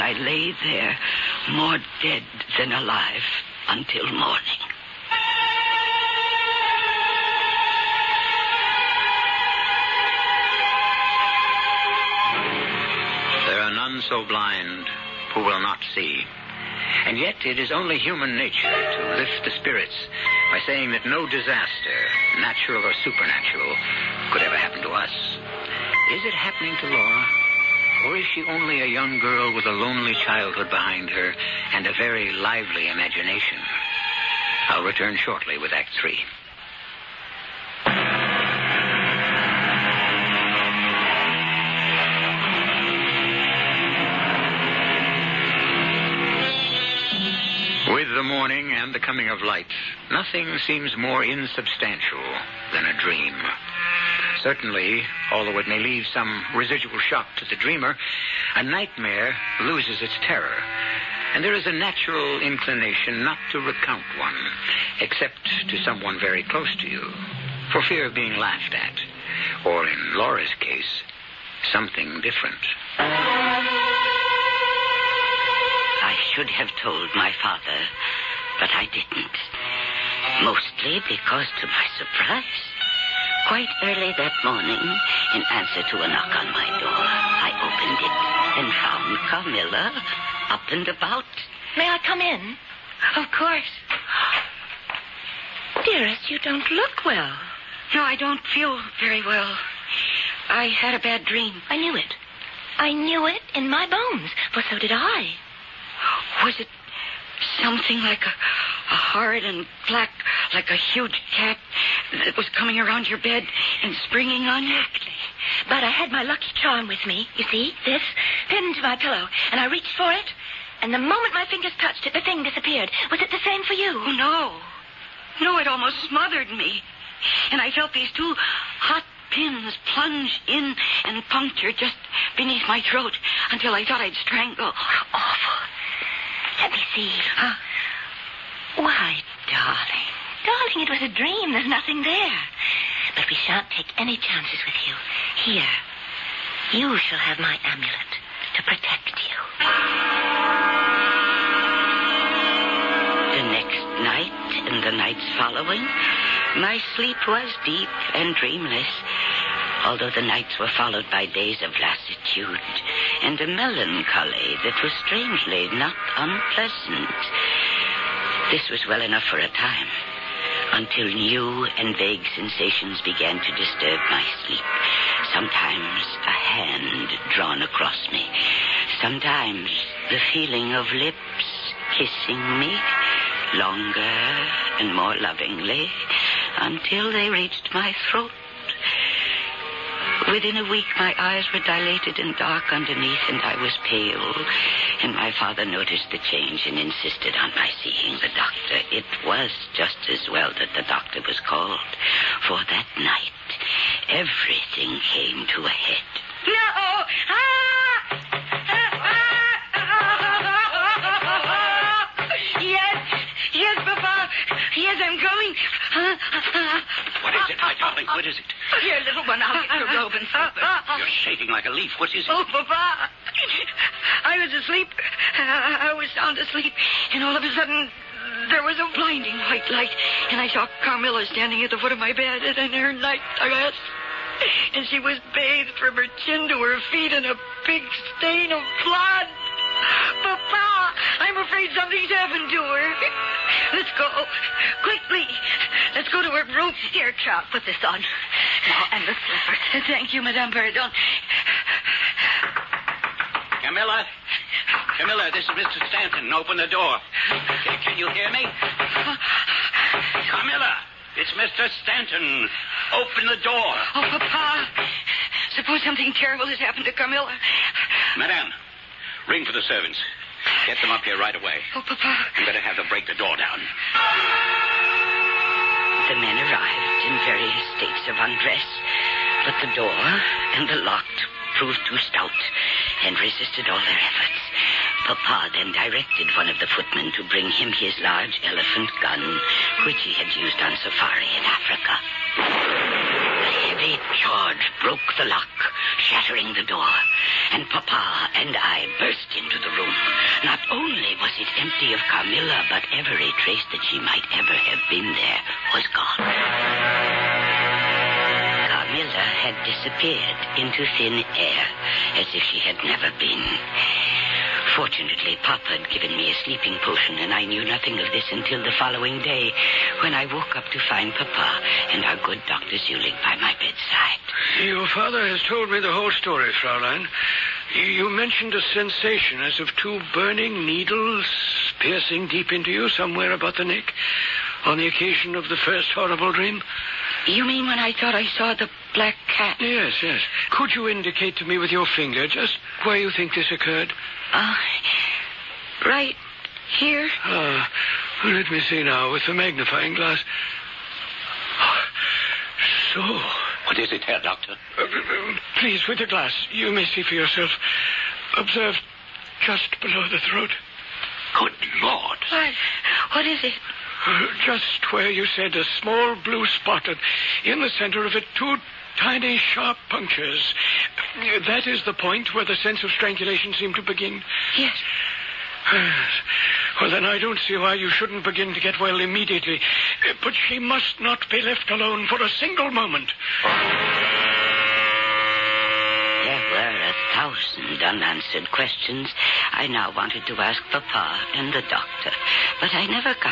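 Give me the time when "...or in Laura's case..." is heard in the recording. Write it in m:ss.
1:09.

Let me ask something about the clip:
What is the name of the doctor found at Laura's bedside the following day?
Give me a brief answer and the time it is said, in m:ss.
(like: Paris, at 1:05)
Dr. Zulig, at 5:22.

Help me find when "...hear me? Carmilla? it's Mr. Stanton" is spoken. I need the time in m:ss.
4:18.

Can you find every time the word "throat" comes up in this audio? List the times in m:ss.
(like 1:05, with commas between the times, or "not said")
2:12, 3:08, 6:00.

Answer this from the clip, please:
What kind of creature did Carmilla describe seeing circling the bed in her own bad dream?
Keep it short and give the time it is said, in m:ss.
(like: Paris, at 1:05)
A huge cat, at 1:50.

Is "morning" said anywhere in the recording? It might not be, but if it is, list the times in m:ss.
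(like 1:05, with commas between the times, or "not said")
0:04, 0:48, 1:24.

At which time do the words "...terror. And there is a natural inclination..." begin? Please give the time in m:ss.
1:00.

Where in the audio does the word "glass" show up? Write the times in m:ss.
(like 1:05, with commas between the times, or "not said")
5:49, 5:56.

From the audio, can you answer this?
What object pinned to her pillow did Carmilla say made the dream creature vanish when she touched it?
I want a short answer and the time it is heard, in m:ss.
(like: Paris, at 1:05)
Lucky charm, at 1:56.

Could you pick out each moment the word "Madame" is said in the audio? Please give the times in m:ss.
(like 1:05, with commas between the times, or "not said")
4:10, 4:28.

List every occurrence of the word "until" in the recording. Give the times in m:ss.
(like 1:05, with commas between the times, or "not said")
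0:03, 2:13, 2:50, 3:06, 5:18.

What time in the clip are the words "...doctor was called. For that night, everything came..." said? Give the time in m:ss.
3:20.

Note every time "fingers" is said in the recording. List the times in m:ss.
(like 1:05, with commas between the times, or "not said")
2:01, 5:41.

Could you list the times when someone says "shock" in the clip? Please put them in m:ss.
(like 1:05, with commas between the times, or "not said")
0:56.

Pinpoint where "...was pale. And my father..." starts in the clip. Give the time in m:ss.
3:13.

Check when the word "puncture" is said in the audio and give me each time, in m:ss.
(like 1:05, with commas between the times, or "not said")
2:11, 6:09.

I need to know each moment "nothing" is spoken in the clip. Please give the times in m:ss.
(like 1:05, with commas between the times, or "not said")
0:50, 2:21, 5:17.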